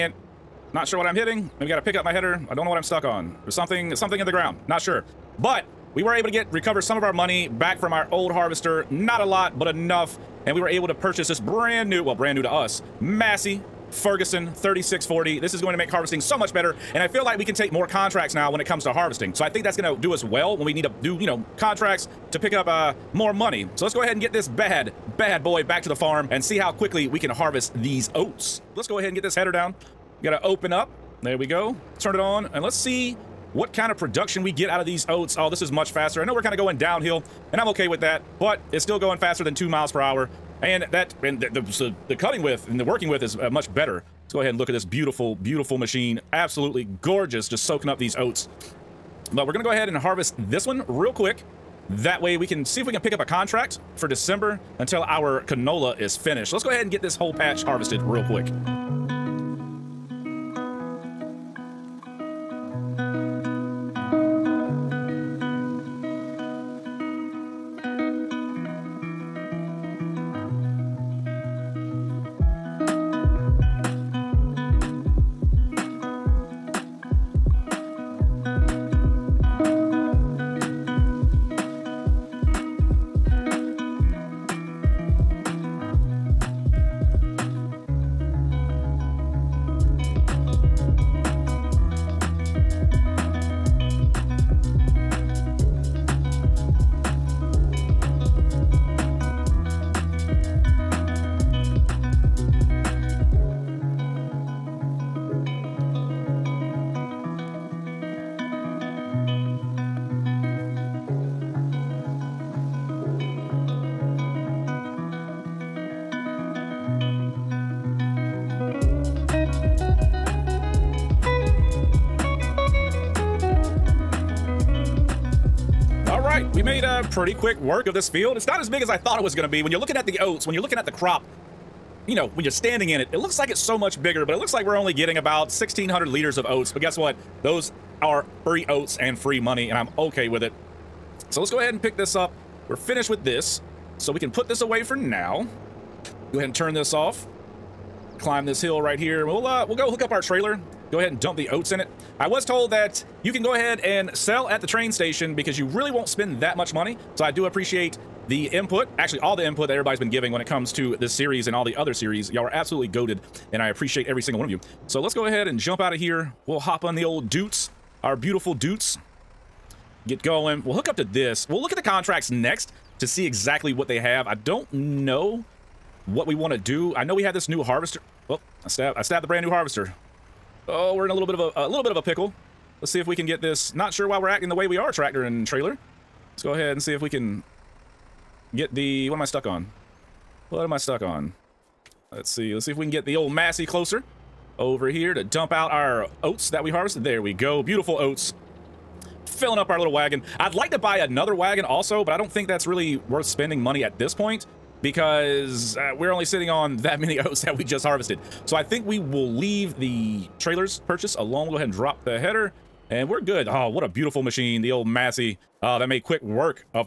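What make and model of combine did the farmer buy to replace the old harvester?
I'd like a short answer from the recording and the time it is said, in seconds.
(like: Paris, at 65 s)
Massey Ferguson 3640, at 13 s.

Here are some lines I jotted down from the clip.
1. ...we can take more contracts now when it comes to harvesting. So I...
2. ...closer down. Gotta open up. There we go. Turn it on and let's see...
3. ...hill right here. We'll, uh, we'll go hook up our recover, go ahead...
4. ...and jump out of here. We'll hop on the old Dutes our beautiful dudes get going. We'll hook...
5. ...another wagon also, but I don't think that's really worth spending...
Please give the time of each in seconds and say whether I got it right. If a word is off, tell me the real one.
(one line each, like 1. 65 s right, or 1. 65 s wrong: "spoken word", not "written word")
1. 17 s right
2. 29 s wrong: "header", not "closer"
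3. 148 s wrong: "trailer", not "recover"
4. 165 s right
5. 200 s right.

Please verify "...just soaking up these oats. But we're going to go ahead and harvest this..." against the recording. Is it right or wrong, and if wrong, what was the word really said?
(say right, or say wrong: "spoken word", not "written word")
right.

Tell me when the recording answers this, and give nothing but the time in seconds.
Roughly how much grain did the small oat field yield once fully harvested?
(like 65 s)
135 s.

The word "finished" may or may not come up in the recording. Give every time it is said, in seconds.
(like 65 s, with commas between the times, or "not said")
56 s, 142 s.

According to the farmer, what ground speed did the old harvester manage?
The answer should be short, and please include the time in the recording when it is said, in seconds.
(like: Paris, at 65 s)
2 miles per hour, at 39 s.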